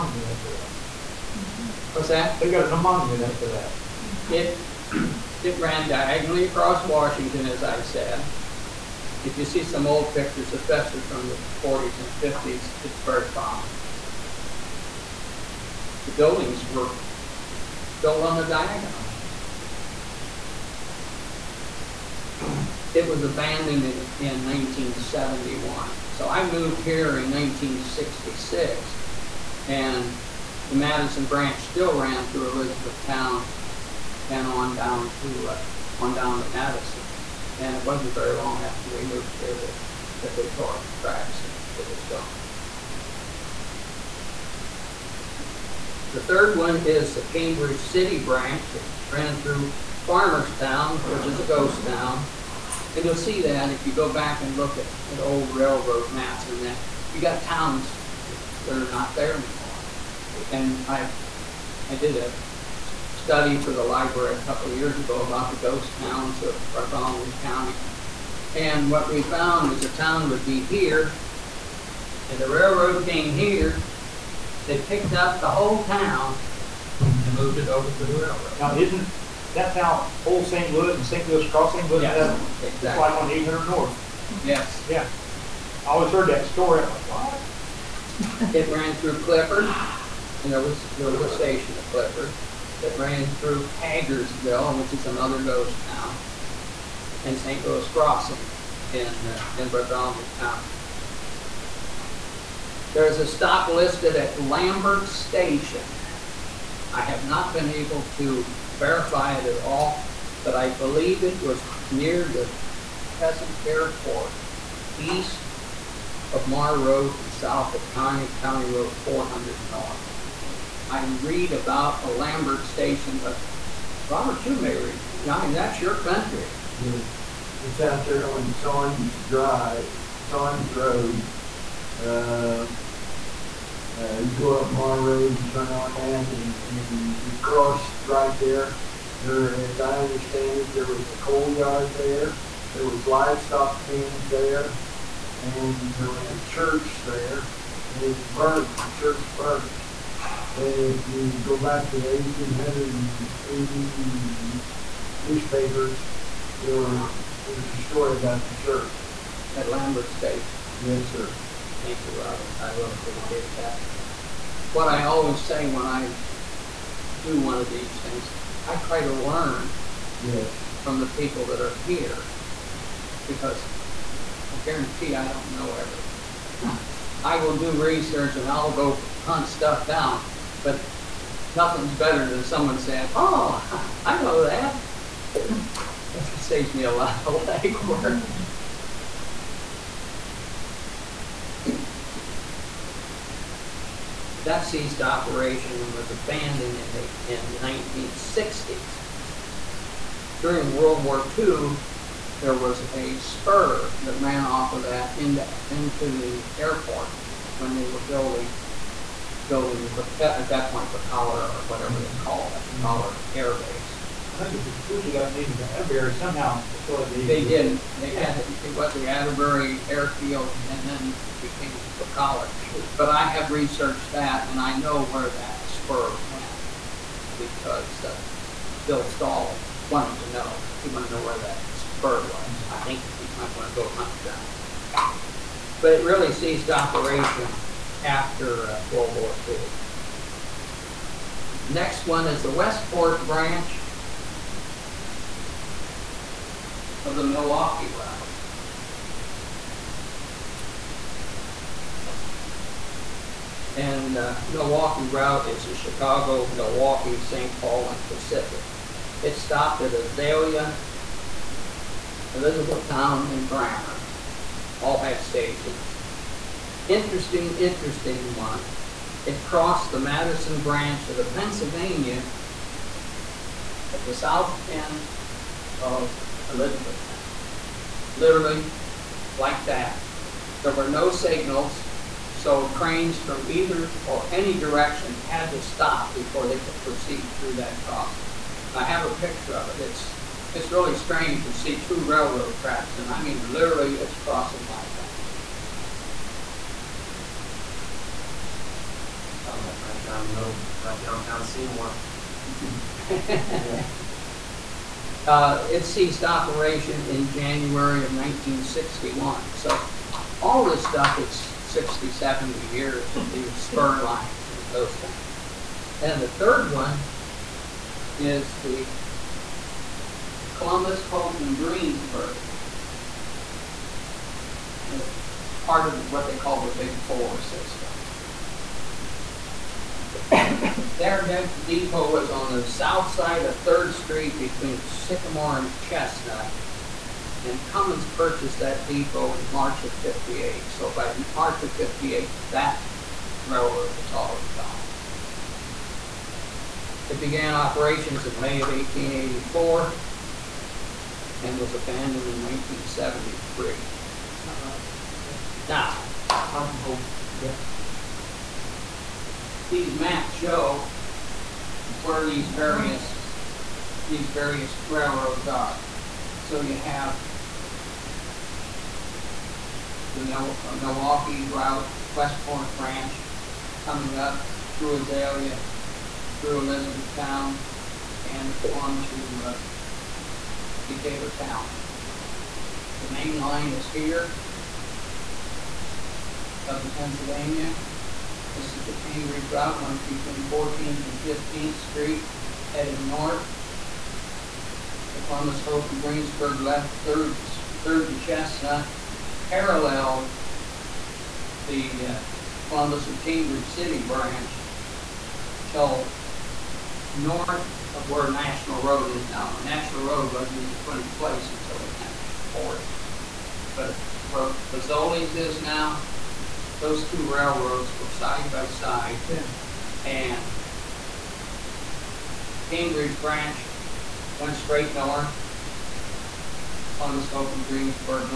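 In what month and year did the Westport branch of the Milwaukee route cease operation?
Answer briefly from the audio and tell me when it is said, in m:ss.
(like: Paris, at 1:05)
January 1961, at 5:07.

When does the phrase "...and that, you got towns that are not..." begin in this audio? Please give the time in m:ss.
0:56.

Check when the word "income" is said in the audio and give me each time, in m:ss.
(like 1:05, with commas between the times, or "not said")
not said.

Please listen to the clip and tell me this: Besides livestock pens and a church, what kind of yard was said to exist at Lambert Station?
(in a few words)
Coal yard.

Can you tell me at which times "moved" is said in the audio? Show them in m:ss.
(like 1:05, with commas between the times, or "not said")
0:26, 0:39, 1:17.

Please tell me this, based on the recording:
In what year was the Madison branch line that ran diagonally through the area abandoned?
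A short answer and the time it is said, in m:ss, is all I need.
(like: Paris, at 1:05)
1971, at 0:24.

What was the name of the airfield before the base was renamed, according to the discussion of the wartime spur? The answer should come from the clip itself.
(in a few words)
Atterbury Airfield.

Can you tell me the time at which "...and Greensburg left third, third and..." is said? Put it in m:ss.
6:35.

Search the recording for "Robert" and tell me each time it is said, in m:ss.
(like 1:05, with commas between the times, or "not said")
2:04, 2:42.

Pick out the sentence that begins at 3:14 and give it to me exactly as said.
That ceased operation and was abandoned in the, in the 1960s.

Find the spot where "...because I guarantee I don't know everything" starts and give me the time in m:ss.
2:53.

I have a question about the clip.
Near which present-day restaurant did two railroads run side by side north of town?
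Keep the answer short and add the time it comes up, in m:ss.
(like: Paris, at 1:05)
Fazoli's, at 6:54.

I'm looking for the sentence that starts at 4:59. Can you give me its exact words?
Sounds like right down the middle, right downtown Seymour.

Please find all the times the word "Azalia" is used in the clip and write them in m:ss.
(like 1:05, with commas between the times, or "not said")
4:19, 6:14.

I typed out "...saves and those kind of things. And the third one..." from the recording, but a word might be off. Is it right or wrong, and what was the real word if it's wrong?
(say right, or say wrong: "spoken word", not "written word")
wrong: "lines", not "saves".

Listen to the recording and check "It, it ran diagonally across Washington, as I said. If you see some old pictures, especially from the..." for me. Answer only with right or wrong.
right.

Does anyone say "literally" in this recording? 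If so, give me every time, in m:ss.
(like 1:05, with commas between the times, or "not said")
4:38, 4:53.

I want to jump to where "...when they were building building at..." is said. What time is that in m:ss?
3:27.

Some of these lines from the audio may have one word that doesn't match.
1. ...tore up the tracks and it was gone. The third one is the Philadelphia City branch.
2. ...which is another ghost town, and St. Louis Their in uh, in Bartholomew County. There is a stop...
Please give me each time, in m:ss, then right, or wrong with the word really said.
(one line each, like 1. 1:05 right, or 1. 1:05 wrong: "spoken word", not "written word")
1. 0:40 wrong: "Cambridge", not "Philadelphia"
2. 1:34 wrong: "Crossing", not "Their".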